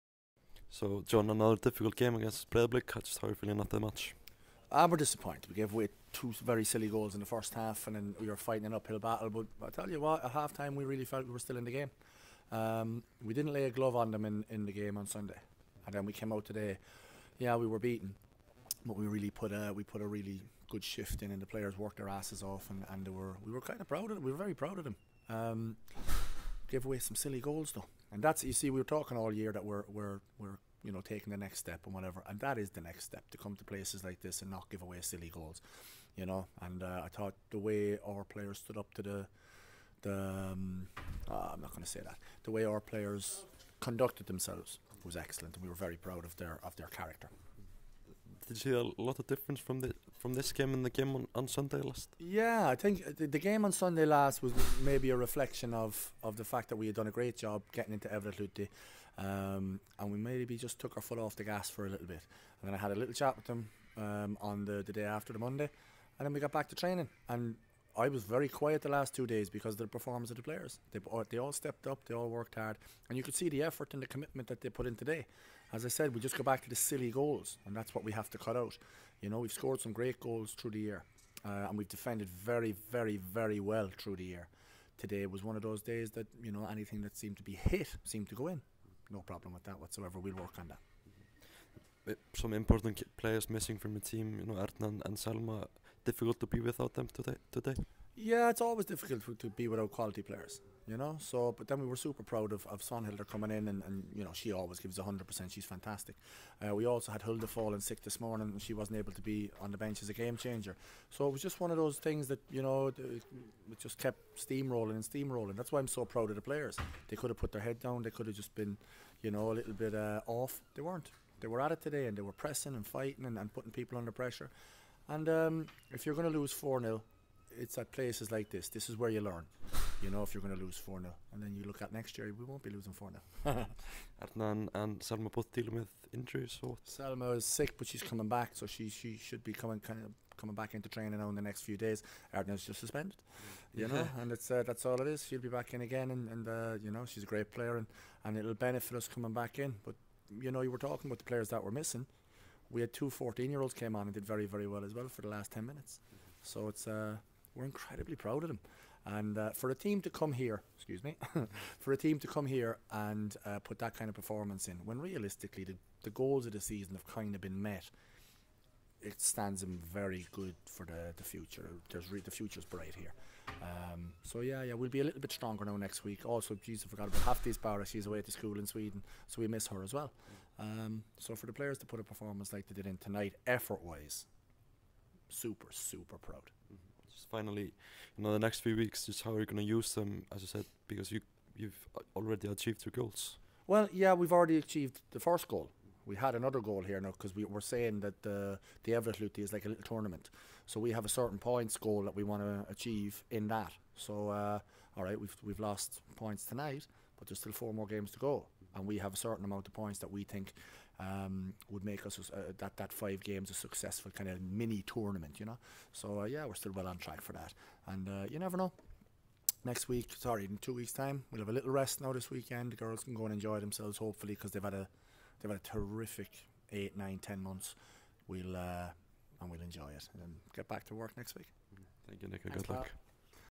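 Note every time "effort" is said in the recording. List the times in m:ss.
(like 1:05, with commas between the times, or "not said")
1:13, 3:03.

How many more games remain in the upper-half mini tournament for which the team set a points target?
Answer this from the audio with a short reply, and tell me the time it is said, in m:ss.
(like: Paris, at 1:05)
4, at 3:27.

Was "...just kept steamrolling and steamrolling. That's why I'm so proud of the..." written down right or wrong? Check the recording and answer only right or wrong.
right.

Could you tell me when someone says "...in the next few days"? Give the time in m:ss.
2:21.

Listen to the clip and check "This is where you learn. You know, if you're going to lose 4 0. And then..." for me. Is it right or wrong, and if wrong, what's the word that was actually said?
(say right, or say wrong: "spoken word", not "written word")
right.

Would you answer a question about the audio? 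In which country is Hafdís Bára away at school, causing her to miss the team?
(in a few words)
Sweden.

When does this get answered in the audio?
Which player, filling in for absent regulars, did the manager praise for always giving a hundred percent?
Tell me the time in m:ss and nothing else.
1:42.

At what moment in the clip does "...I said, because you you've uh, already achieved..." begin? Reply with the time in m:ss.
3:10.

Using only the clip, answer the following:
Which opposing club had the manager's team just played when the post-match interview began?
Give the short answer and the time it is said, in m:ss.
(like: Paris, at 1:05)
Breiðablik, at 0:02.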